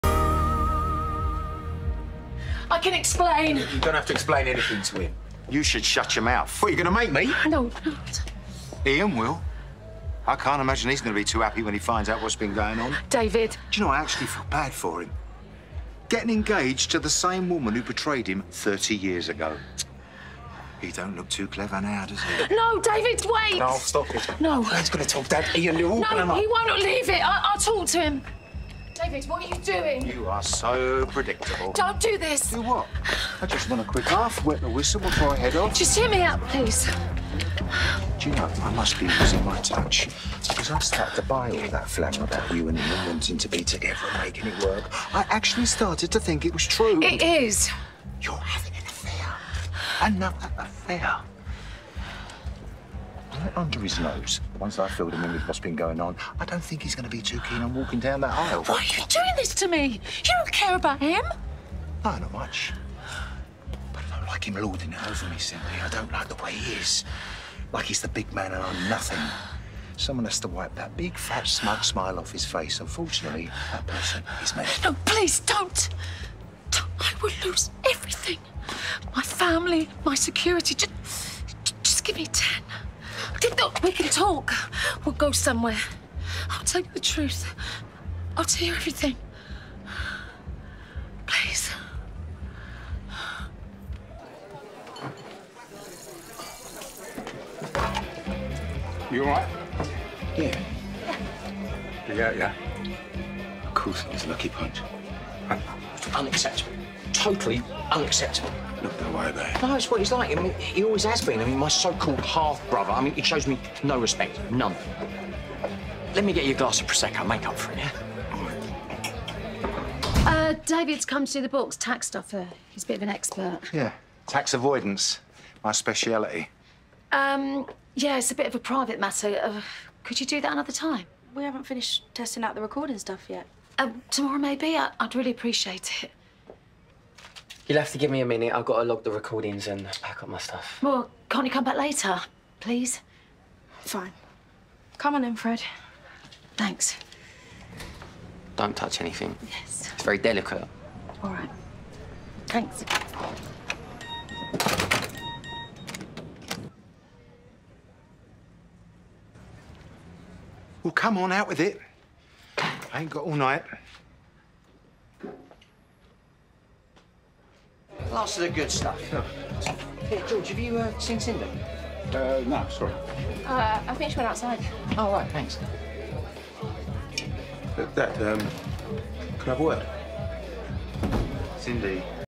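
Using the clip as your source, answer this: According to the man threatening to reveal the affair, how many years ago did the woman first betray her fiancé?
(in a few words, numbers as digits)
30.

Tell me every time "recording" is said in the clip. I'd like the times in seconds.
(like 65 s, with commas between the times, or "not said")
132 s, 139 s.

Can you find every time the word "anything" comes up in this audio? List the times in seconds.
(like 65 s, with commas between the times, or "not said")
4 s, 148 s.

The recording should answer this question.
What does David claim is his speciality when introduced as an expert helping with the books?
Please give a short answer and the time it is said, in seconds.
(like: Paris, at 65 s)
Tax avoidance, at 124 s.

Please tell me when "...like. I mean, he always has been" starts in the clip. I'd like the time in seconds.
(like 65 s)
110 s.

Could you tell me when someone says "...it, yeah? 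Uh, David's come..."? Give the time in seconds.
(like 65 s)
117 s.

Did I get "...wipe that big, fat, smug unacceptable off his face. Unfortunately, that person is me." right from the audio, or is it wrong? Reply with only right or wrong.
wrong.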